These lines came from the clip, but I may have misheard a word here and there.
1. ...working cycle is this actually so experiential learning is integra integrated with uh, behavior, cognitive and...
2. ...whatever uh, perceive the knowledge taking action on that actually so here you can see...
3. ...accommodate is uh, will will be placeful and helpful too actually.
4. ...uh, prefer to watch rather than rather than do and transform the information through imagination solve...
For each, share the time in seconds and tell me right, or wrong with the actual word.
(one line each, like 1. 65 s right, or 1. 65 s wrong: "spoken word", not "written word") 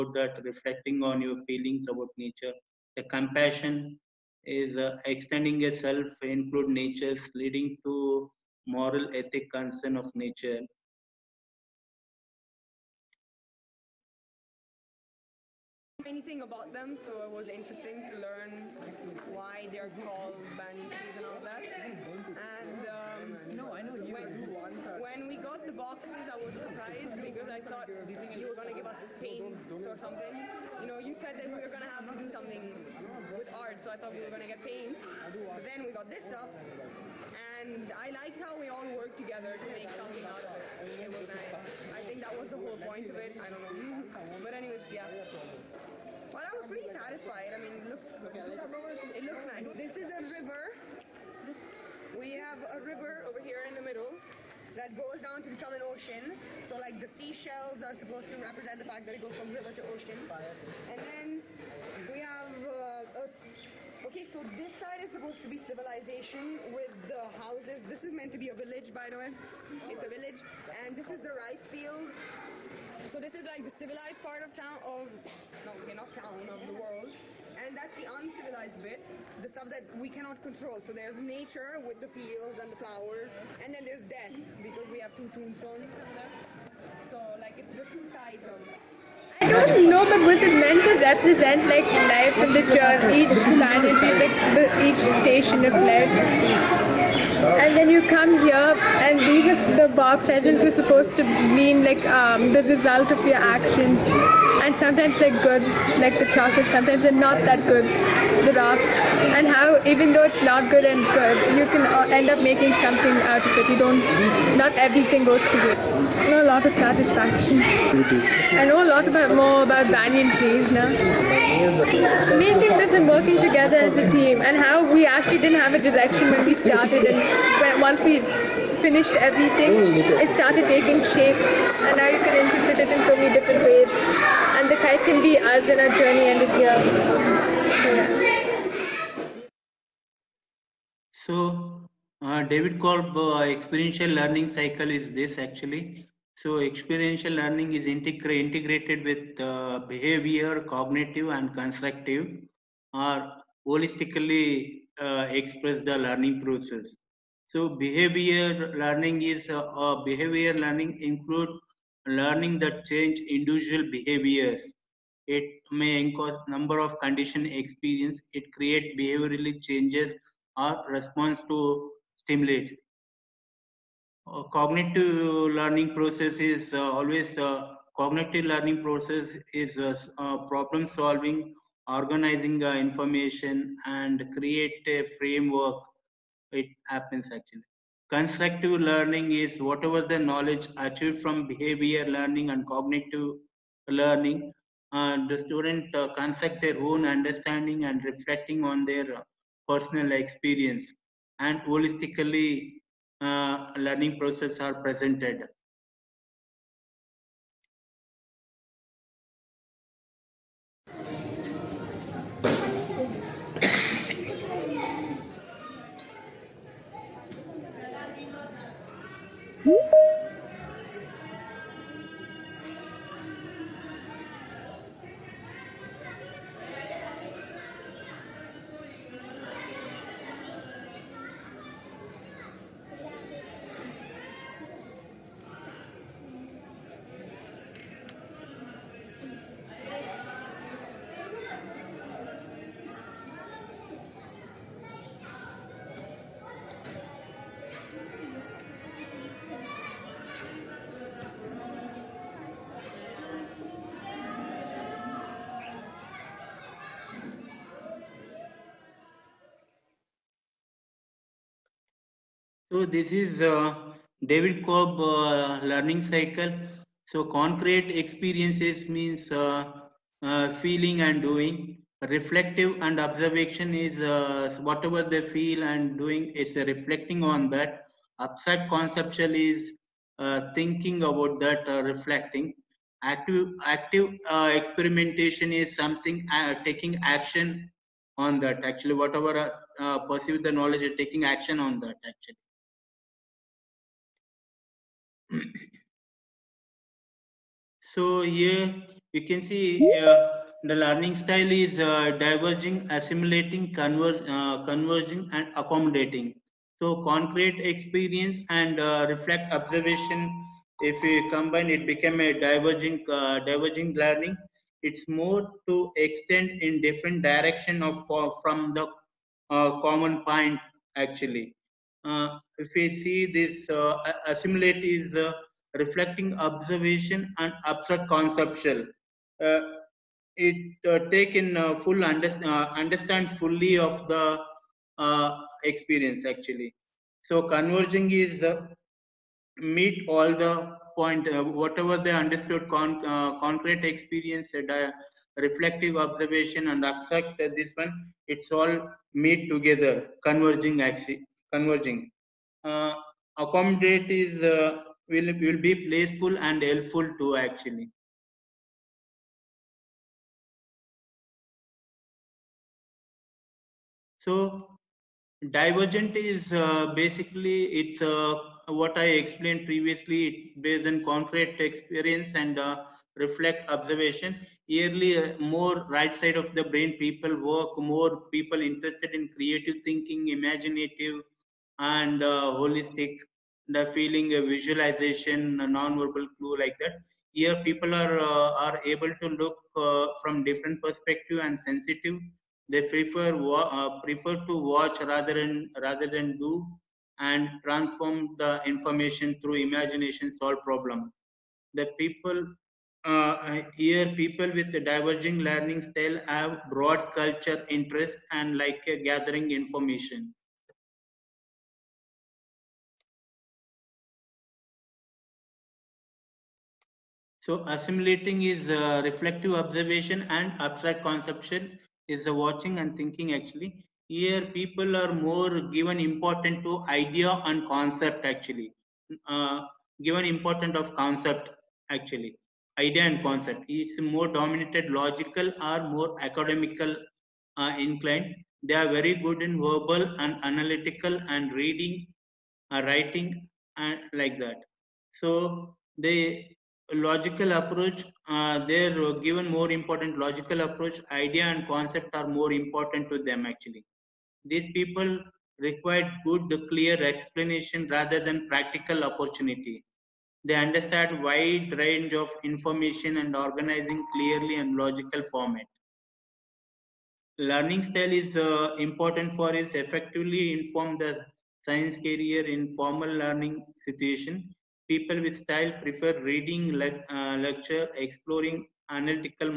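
1. 144 s wrong: "learning", not "working"
2. 288 s right
3. 353 s right
4. 393 s right.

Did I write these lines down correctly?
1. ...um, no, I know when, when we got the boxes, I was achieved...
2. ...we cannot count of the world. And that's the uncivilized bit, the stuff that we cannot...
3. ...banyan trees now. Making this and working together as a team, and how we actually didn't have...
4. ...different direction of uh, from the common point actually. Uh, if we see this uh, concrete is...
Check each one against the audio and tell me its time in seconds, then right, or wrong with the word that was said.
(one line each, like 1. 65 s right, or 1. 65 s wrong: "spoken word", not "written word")
1. 22 s wrong: "surprised", not "achieved"
2. 75 s right
3. 119 s right
4. 316 s wrong: "assimilate", not "concrete".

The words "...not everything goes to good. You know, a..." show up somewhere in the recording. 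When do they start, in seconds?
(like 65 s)
114 s.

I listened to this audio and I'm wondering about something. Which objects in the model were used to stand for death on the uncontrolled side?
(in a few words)
two tombstones.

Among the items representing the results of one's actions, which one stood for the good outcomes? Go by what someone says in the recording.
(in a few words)
chocolate.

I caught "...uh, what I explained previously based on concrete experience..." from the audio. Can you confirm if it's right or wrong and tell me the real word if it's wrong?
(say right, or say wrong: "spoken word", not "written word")
right.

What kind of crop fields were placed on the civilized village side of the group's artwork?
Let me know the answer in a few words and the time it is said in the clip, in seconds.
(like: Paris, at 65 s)
rice fields, at 71 s.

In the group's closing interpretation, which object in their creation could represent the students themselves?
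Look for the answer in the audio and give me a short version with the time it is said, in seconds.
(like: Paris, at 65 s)
the kite, at 134 s.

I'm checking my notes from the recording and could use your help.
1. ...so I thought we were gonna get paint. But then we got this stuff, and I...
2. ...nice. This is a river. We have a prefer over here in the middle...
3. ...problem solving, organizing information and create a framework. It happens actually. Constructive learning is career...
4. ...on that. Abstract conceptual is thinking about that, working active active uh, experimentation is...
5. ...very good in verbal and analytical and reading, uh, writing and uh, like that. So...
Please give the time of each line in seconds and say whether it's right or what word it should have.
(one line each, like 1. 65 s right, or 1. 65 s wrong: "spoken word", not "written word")
1. 33 s right
2. 49 s wrong: "river", not "prefer"
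3. 180 s wrong: "whatever", not "career"
4. 277 s wrong: "reflecting", not "working"
5. 438 s right.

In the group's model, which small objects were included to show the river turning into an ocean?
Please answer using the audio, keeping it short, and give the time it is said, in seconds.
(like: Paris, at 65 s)
seashells, at 57 s.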